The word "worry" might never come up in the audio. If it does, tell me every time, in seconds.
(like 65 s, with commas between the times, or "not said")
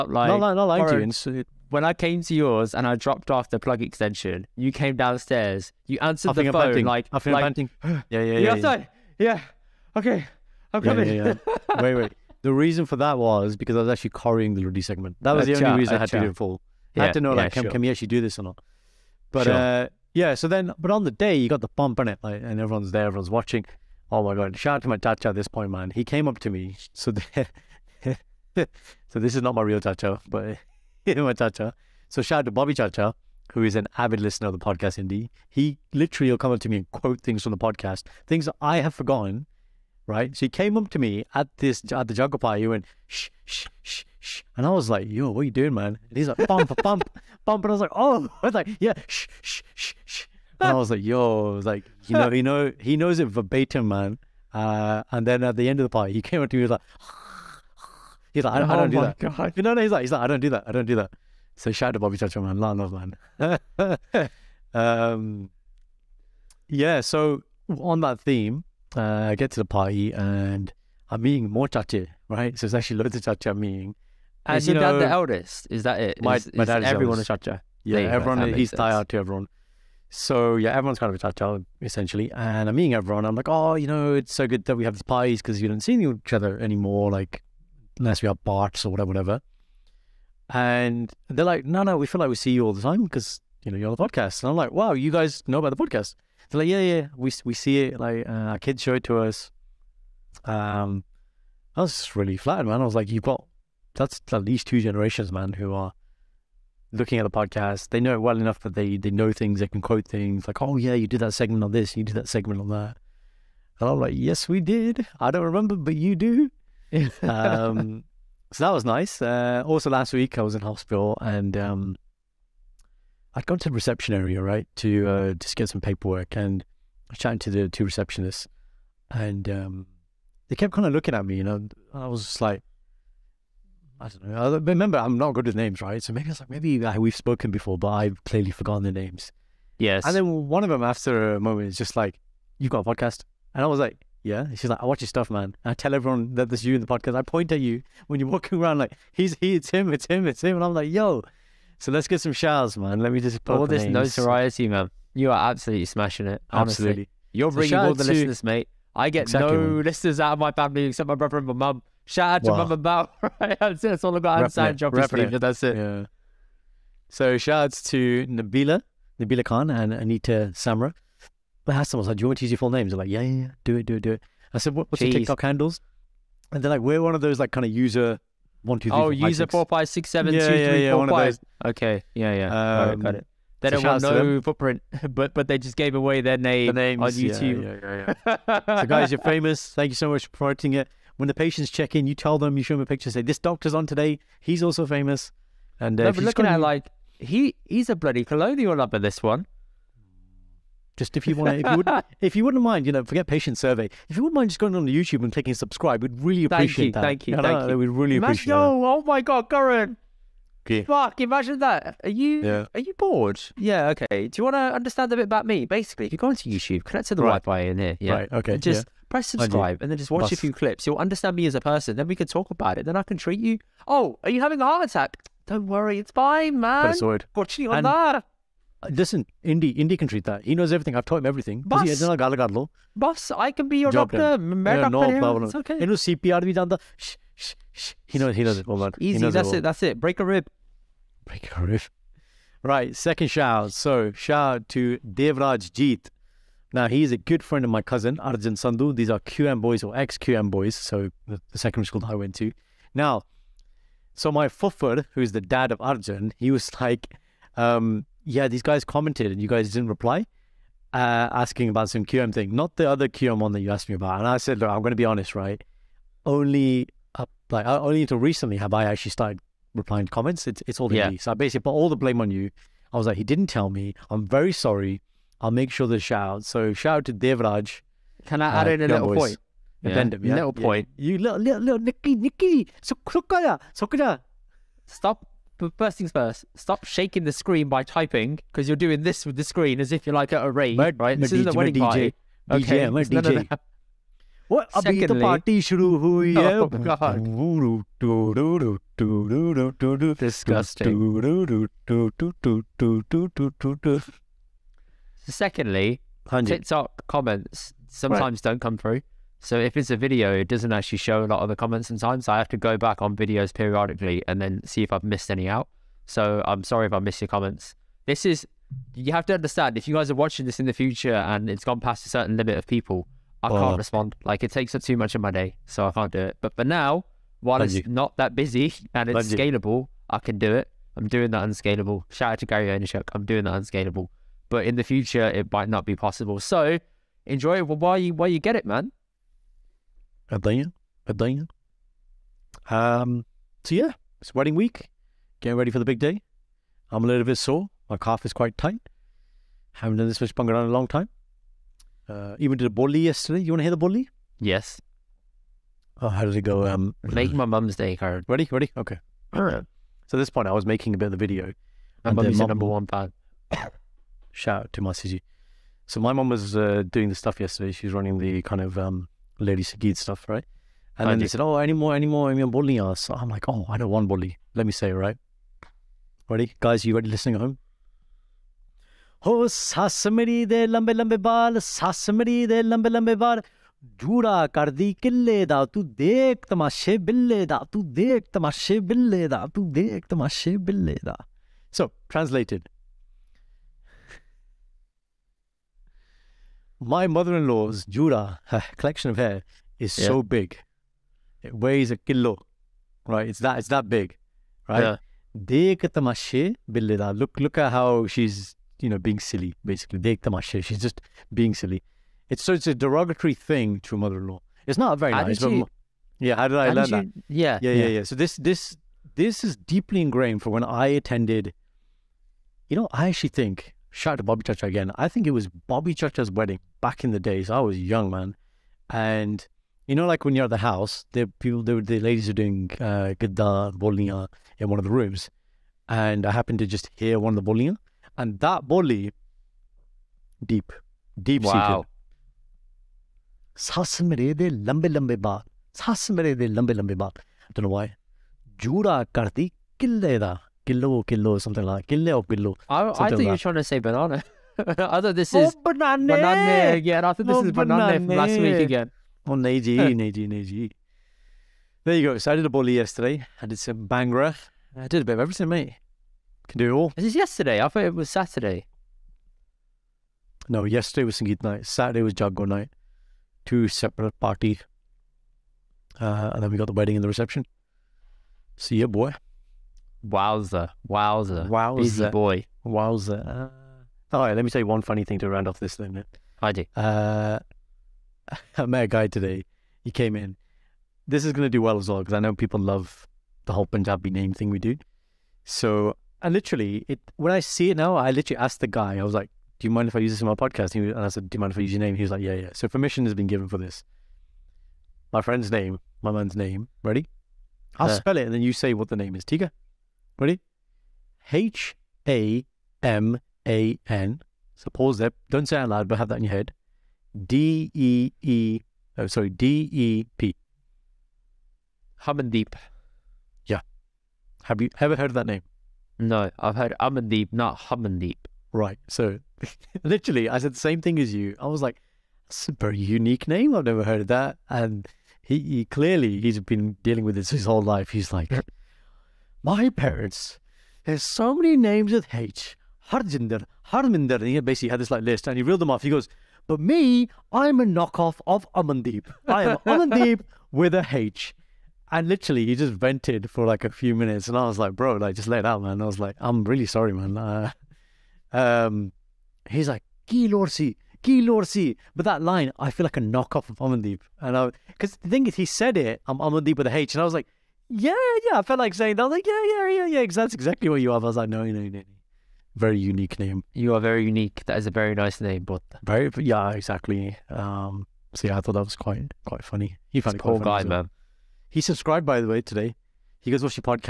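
225 s.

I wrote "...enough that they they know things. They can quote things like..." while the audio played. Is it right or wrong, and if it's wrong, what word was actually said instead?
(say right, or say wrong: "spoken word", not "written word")
right.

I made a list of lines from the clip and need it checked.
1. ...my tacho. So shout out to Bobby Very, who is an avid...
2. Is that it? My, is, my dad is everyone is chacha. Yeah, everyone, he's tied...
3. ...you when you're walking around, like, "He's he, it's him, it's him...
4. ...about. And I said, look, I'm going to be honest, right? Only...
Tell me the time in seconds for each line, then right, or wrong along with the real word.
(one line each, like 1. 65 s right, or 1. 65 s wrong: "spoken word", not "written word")
1. 31 s wrong: "Chacha", not "Very"
2. 75 s right
3. 147 s right
4. 263 s right.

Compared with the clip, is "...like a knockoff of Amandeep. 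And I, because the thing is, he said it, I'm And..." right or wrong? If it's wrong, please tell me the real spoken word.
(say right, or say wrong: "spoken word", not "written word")
wrong: "Amandeep", not "And".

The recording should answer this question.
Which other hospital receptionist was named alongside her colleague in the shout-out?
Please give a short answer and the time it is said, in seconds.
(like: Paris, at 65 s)
Anita Samra, at 169 s.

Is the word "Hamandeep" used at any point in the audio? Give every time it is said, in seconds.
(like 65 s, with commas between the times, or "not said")
522 s, 527 s.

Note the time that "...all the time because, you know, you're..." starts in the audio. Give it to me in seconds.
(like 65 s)
92 s.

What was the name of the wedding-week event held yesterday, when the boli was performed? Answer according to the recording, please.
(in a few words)
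Sangeet night.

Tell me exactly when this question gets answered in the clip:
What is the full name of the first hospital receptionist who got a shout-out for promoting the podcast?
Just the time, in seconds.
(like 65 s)
169 s.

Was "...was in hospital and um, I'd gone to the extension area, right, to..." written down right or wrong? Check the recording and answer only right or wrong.
wrong.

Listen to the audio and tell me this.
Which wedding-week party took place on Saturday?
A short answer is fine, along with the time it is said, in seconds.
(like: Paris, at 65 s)
Jago night, at 472 s.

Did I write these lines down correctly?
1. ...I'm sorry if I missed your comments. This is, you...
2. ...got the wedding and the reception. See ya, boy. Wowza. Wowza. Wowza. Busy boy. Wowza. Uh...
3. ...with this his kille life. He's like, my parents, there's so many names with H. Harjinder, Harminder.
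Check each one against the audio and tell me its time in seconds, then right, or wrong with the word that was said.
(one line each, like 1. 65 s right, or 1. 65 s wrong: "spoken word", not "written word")
1. 316 s right
2. 476 s right
3. 537 s wrong: "whole", not "kille".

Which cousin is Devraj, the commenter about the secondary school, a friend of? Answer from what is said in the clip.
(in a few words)
Arjun Sandhu.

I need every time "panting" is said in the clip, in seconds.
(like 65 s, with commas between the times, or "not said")
7 s.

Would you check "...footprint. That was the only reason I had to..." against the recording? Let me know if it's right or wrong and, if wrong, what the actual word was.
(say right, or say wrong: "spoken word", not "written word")
wrong: "segment", not "footprint".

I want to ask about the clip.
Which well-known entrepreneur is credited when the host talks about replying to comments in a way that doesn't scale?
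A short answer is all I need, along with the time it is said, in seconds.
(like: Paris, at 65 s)
Gary Vaynerchuk, at 332 s.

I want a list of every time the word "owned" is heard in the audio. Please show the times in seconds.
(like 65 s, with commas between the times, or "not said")
not said.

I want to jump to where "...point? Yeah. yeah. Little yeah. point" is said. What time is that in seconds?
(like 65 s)
279 s.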